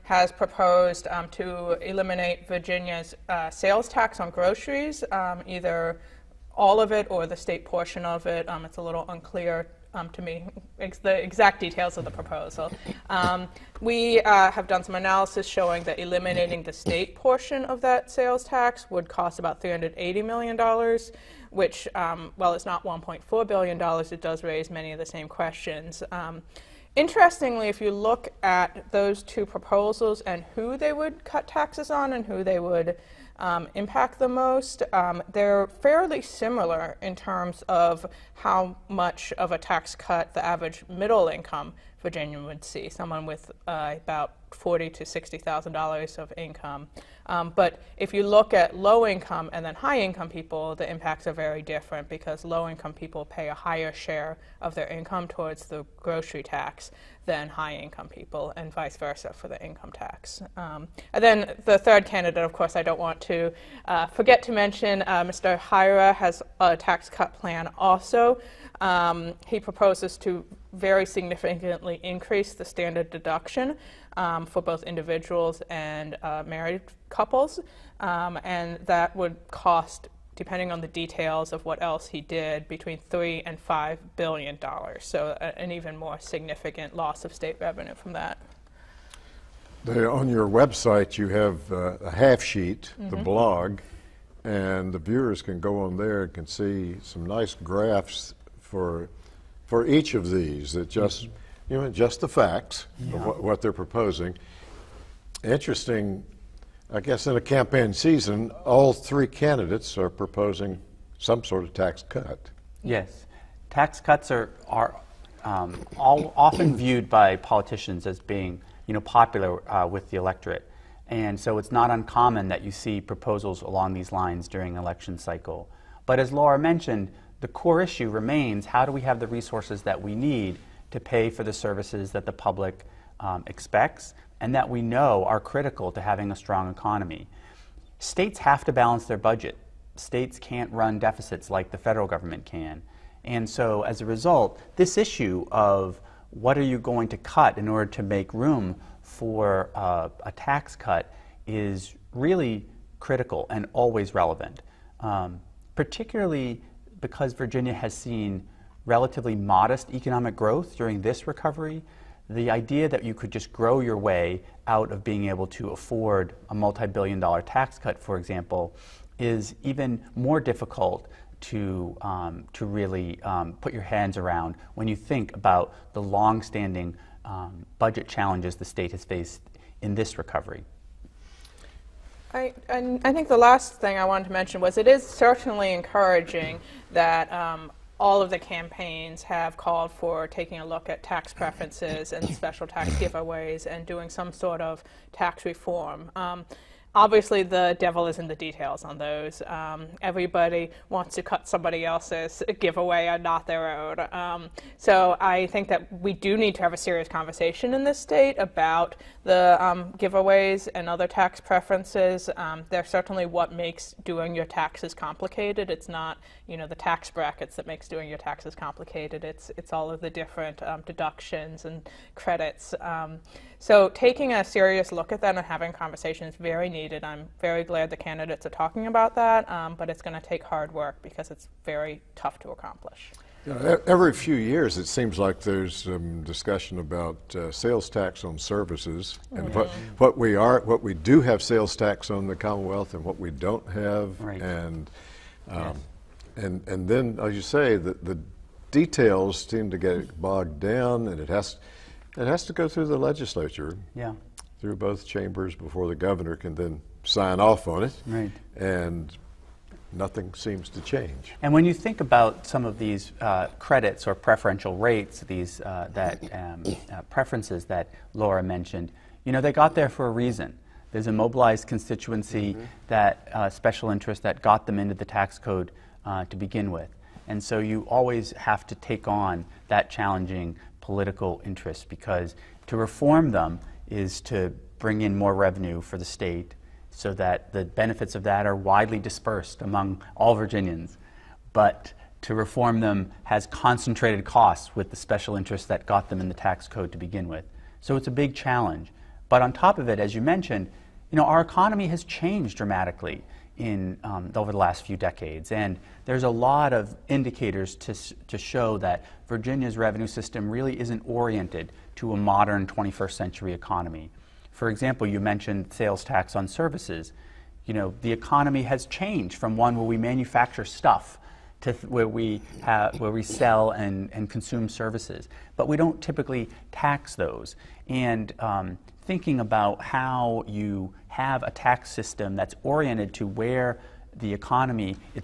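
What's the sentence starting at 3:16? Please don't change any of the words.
Um, obviously the devil is in the details on those.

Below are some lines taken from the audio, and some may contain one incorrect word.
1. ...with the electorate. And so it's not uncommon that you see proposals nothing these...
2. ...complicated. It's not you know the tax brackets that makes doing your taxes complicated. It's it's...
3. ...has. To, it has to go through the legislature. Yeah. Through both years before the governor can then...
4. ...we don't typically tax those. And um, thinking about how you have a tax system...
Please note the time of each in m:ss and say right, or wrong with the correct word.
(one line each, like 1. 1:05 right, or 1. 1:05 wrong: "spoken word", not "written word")
1. 1:59 wrong: "along", not "nothing"
2. 3:34 right
3. 4:11 wrong: "chambers", not "years"
4. 5:25 right.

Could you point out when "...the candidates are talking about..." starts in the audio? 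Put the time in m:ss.
3:47.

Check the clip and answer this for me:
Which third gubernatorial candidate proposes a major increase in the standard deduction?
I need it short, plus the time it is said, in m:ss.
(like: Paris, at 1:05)
Hyra, at 1:05.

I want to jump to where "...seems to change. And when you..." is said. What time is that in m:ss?
4:20.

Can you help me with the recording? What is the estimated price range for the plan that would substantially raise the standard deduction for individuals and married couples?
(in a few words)
$3 to $5 billion.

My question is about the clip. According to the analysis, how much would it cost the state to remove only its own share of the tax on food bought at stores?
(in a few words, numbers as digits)
$380 million.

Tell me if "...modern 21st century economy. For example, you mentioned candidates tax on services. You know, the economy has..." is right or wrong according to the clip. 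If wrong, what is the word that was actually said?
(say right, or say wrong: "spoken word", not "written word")
wrong: "sales", not "candidates".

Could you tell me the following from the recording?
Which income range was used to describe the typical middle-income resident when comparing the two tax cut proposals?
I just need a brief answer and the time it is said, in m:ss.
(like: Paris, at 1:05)
$40,000 to $60,000, at 0:44.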